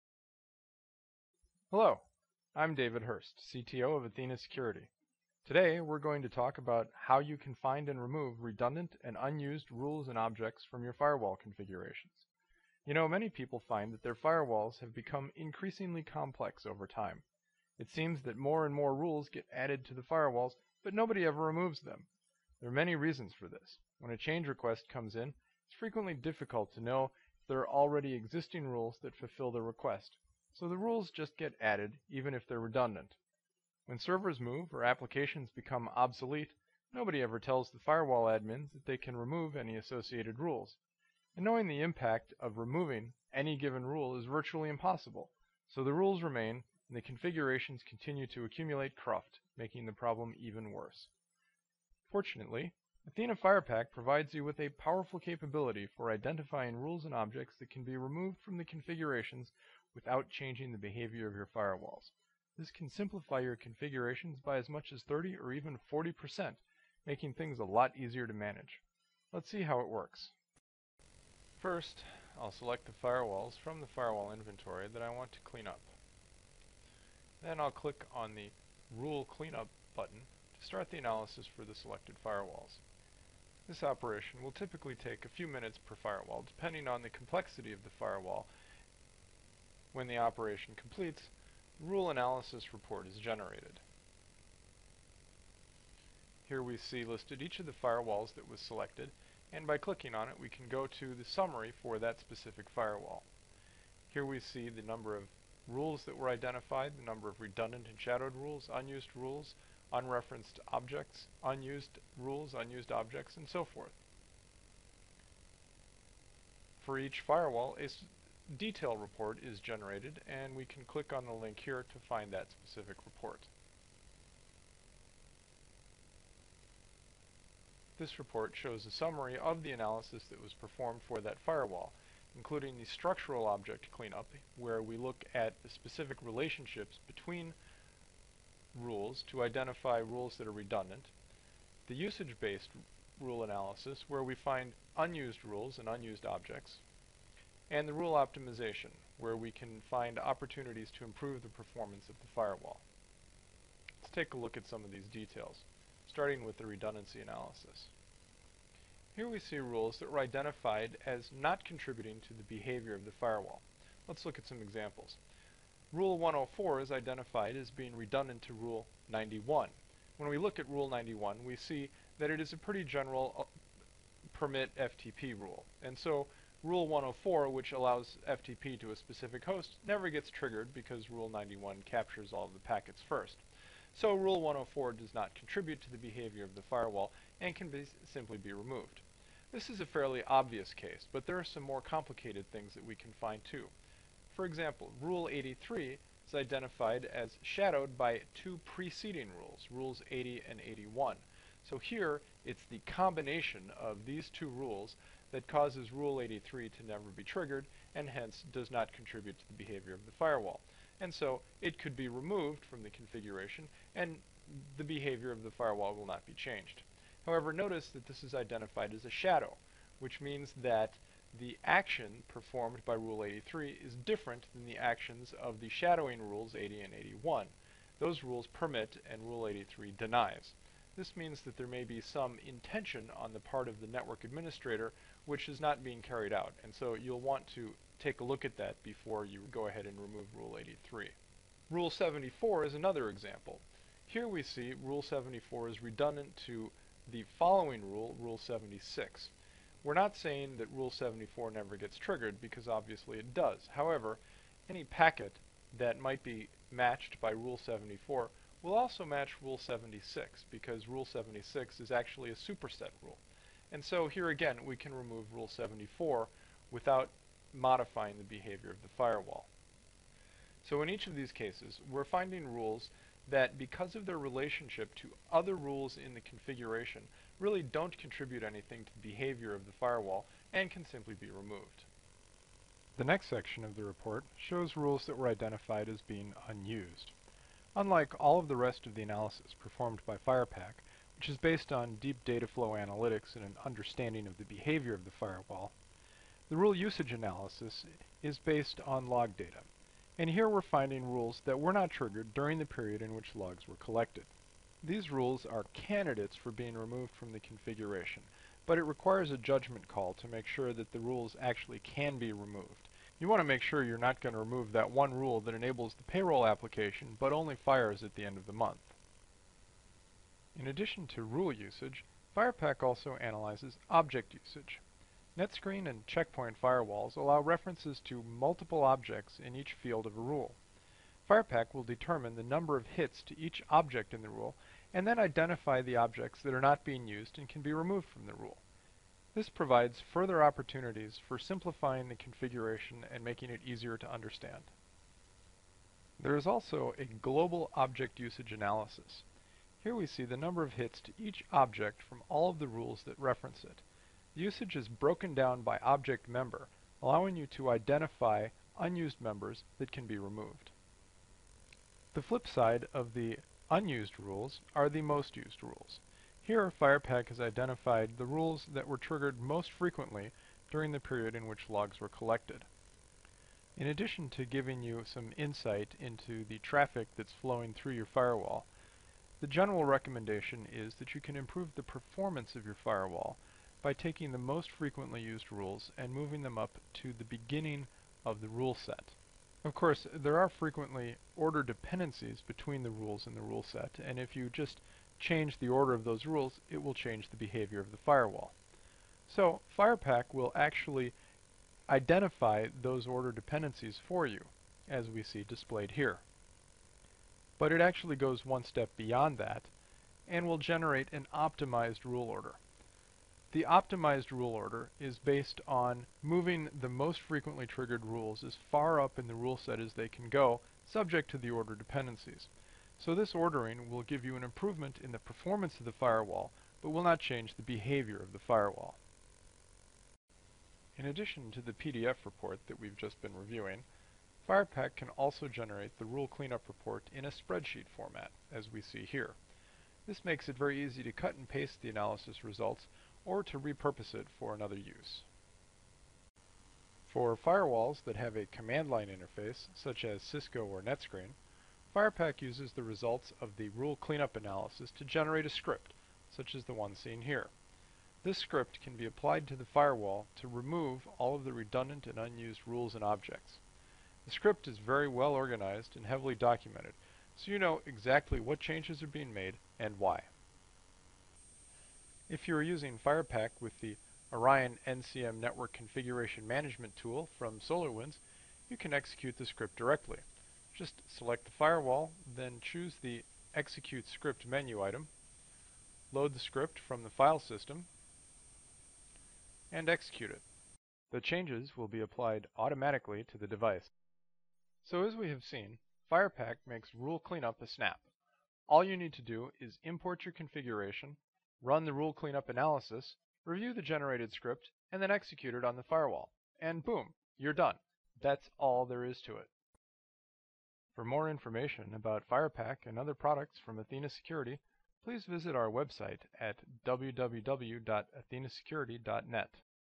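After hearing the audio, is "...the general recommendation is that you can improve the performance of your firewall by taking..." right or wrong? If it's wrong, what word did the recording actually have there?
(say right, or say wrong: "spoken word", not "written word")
right.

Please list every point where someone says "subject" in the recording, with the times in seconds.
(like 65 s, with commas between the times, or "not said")
420 s.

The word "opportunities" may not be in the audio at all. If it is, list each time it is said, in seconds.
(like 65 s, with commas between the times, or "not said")
150 s, 340 s.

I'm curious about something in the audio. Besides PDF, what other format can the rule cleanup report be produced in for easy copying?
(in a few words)
spreadsheet.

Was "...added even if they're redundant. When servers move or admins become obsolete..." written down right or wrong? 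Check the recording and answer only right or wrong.
wrong.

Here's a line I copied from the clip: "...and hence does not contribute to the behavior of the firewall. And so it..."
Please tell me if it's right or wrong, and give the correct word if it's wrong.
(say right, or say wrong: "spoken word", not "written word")
right.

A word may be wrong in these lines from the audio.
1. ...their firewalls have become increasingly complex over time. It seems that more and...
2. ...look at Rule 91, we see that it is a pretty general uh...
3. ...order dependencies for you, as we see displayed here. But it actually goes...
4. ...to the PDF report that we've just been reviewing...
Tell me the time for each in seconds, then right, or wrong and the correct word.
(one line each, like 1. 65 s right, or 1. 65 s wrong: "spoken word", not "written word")
1. 14 s right
2. 170 s right
3. 403 s right
4. 431 s right.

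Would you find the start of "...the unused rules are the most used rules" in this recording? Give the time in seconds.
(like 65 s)
363 s.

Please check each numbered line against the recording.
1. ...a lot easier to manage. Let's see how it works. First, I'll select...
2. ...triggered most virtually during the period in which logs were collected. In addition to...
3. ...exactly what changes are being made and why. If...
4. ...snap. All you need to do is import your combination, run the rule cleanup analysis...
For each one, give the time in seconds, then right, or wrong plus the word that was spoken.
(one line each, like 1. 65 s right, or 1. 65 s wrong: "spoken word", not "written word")
1. 67 s right
2. 368 s wrong: "frequently", not "virtually"
3. 467 s right
4. 497 s wrong: "configuration", not "combination".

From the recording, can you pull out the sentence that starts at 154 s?
Let's take a look at some of these details, starting with the redundancy analysis.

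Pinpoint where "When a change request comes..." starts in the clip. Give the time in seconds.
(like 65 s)
23 s.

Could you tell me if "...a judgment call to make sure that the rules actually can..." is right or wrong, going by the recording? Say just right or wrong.
right.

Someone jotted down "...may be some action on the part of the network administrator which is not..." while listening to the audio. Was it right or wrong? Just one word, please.
wrong.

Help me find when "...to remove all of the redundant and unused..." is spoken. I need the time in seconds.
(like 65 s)
460 s.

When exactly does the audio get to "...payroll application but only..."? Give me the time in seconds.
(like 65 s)
316 s.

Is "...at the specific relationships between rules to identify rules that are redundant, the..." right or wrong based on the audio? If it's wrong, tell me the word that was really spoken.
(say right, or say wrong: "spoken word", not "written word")
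right.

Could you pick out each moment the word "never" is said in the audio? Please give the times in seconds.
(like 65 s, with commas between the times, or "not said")
179 s, 206 s, 251 s.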